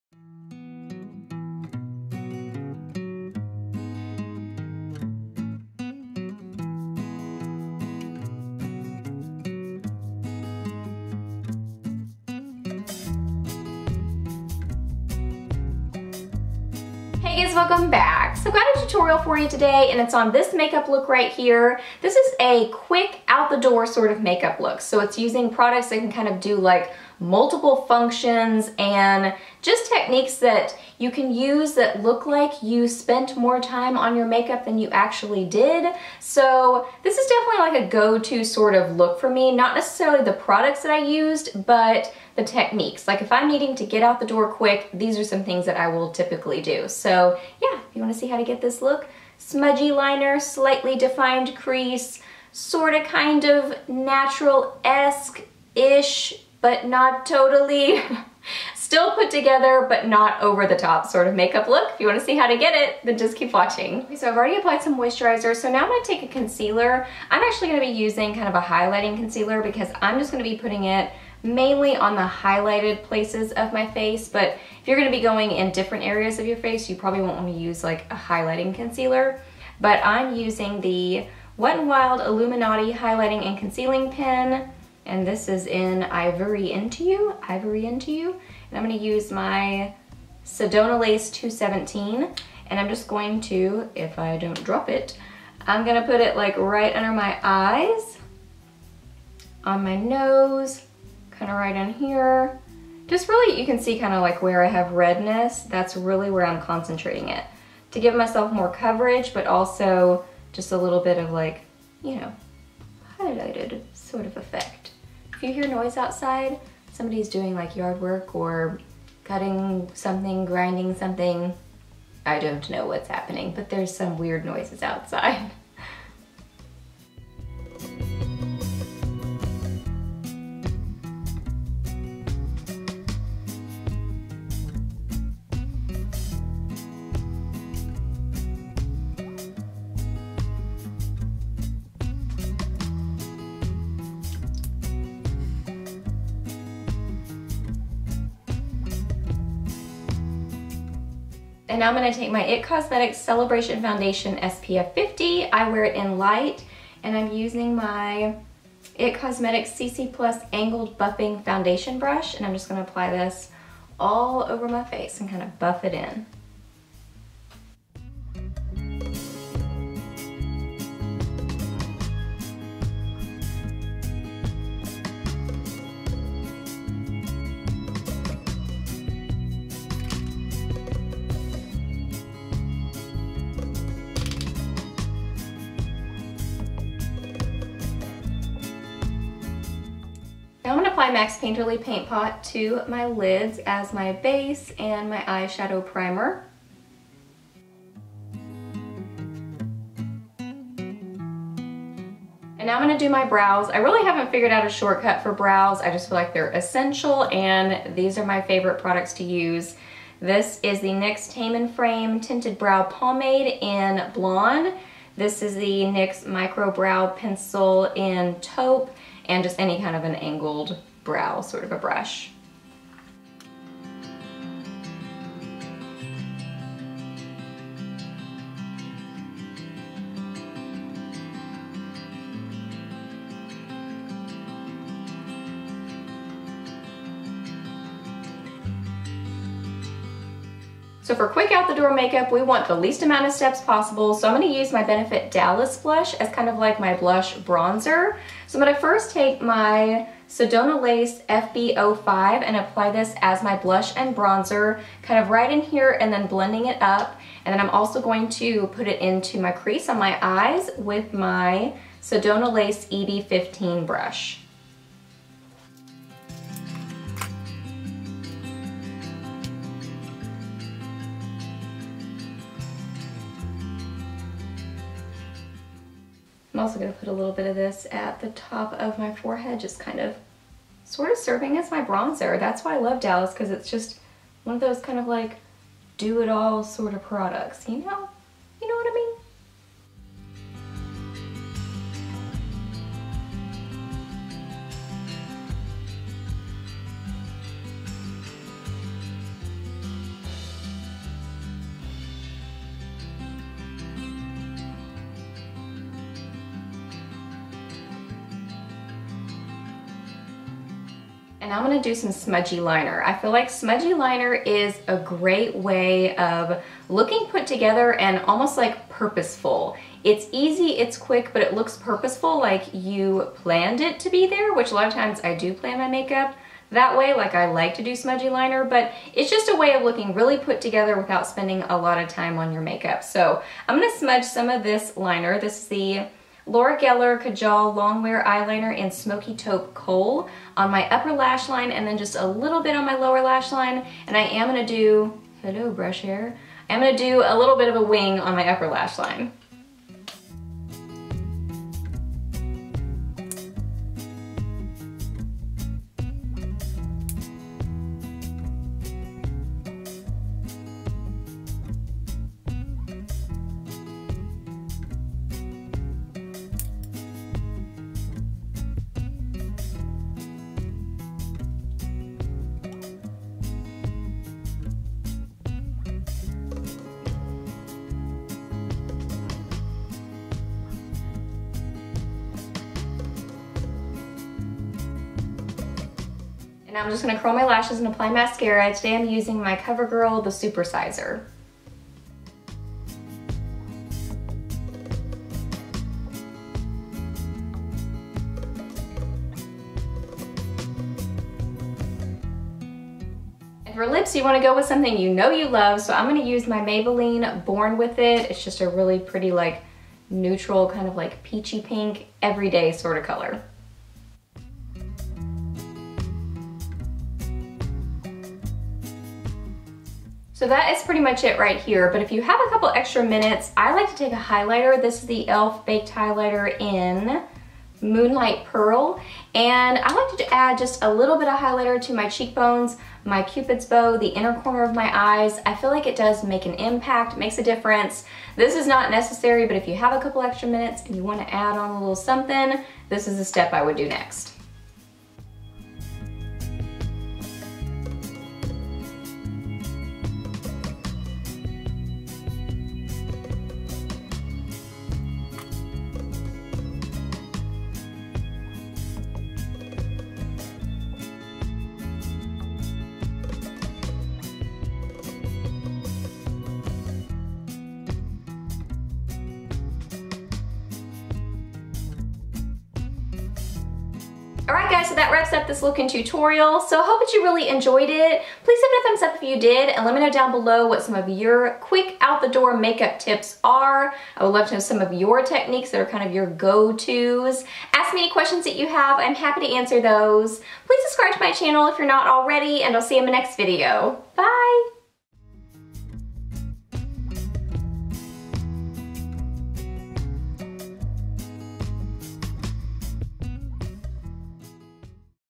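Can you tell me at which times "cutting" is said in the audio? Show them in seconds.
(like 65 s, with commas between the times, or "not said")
119 s.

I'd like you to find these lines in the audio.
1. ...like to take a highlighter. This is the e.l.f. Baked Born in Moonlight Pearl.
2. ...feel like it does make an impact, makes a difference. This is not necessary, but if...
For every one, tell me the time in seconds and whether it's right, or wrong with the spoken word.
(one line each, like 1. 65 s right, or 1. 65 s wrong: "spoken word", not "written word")
1. 423 s wrong: "Highlighter", not "Born"
2. 435 s right.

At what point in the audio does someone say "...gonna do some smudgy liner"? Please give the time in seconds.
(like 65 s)
311 s.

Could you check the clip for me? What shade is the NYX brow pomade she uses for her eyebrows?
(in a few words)
Blonde.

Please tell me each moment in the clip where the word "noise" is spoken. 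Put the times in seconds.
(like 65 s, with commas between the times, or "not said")
115 s, 124 s.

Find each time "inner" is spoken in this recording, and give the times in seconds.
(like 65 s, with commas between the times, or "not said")
434 s.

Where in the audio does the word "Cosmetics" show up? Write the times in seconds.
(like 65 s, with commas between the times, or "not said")
152 s, 159 s.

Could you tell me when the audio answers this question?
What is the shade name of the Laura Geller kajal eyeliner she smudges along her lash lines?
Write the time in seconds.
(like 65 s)
338 s.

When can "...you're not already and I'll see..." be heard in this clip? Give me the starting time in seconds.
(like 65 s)
491 s.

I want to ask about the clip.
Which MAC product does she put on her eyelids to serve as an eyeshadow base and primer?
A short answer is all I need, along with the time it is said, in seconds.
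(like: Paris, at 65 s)
Painterly Paint Pot, at 191 s.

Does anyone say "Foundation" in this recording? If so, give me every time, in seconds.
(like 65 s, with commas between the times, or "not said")
153 s, 161 s.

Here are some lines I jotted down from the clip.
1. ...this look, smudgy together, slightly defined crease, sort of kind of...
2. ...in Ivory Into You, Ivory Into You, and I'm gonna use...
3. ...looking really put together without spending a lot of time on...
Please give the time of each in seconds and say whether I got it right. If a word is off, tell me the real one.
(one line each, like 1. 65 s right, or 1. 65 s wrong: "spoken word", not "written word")
1. 48 s wrong: "liner", not "together"
2. 85 s right
3. 329 s right.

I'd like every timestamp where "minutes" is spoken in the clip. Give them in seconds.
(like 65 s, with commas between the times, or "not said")
423 s, 440 s.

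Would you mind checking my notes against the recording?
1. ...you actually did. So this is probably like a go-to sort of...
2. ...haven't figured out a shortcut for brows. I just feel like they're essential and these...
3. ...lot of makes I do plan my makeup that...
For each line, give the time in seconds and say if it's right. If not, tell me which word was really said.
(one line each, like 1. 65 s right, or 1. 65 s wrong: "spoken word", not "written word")
1. 34 s wrong: "definitely", not "probably"
2. 204 s right
3. 324 s wrong: "times", not "makes".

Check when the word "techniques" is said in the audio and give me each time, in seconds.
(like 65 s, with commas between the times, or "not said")
29 s, 42 s, 485 s.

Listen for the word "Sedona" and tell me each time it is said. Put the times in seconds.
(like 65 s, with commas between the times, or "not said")
90 s, 250 s, 262 s.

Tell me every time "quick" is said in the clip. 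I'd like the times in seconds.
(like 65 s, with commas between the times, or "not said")
22 s, 44 s, 241 s, 320 s, 481 s.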